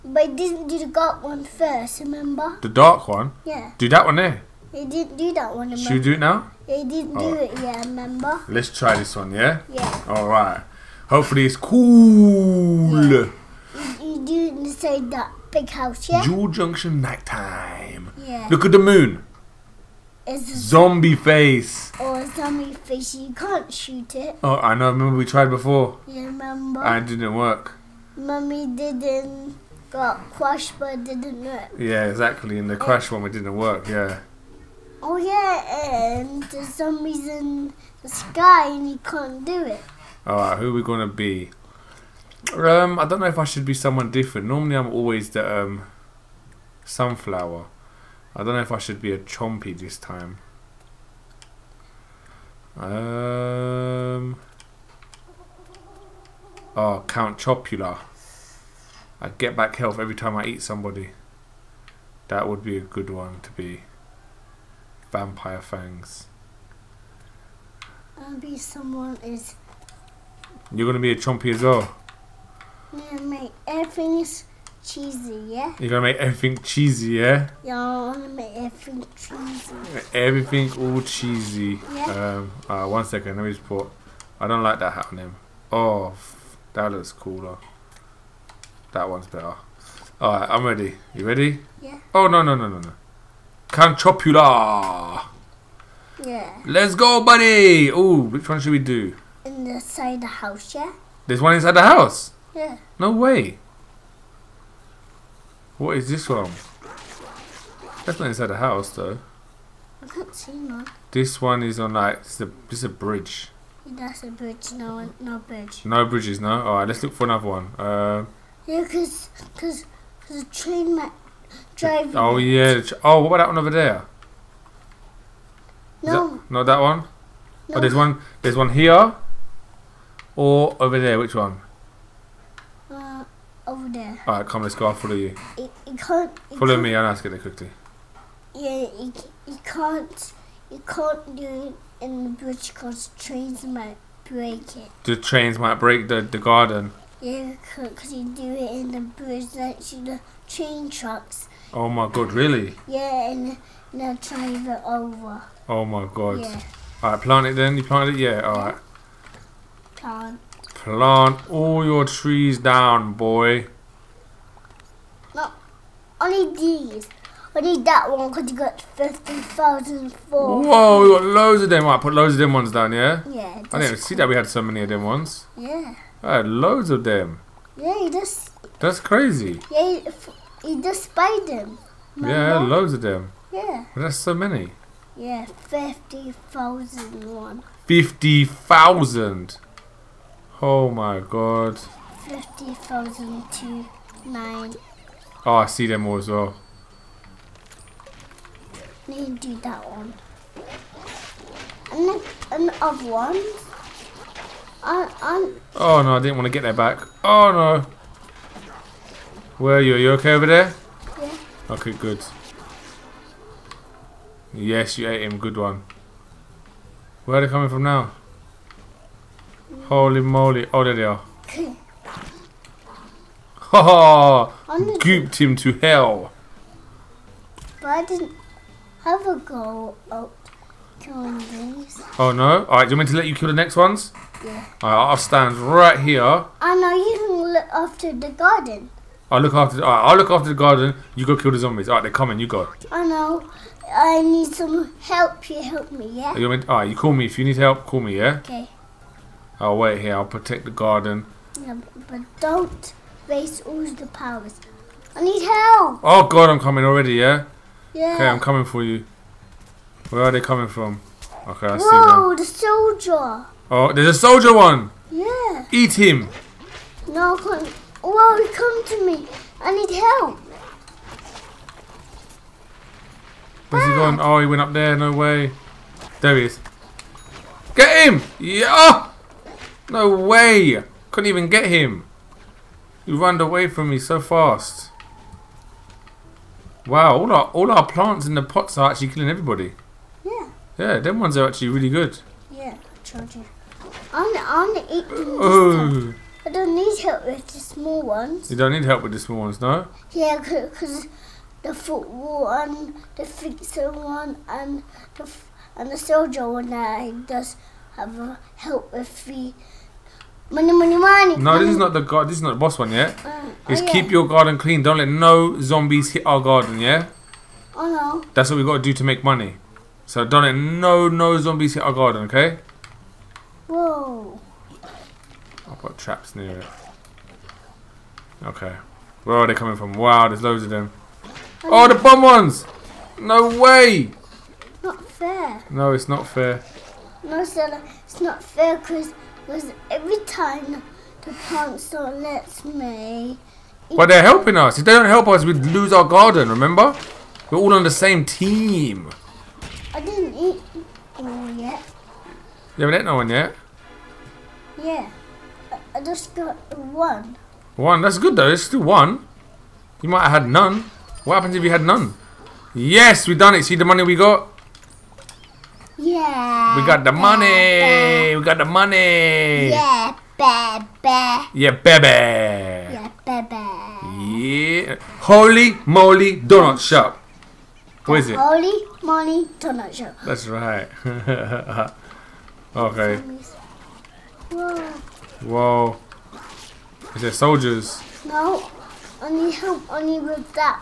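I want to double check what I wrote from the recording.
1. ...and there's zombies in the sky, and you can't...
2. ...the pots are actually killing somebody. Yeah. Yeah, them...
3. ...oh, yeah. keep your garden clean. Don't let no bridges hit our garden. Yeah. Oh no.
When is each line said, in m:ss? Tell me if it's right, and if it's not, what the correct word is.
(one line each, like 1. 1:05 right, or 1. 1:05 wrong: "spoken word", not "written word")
1. 0:36 right
2. 4:48 wrong: "everybody", not "somebody"
3. 5:13 wrong: "zombies", not "bridges".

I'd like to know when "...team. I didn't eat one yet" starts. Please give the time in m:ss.
5:48.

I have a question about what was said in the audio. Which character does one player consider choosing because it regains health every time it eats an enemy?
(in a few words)
Count Chompula.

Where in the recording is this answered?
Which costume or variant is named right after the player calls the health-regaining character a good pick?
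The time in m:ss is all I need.
1:05.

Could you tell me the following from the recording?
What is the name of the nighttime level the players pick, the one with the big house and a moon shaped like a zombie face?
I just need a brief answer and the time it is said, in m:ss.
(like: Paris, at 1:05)
Jewel Junction, at 0:16.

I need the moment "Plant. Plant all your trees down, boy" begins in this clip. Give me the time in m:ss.
2:39.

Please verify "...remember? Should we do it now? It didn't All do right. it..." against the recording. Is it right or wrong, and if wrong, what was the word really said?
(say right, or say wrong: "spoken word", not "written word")
right.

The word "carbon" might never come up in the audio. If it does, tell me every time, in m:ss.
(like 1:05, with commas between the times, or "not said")
not said.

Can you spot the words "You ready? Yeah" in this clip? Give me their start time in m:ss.
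1:31.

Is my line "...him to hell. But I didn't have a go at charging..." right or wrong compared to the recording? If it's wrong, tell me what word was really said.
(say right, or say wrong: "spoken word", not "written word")
wrong: "killing", not "charging".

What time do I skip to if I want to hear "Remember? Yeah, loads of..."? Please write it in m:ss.
3:02.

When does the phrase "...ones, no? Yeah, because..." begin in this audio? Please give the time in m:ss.
4:59.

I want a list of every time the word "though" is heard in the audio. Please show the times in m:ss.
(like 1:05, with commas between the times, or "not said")
1:48, 5:58.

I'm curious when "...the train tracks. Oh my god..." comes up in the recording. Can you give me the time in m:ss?
2:29.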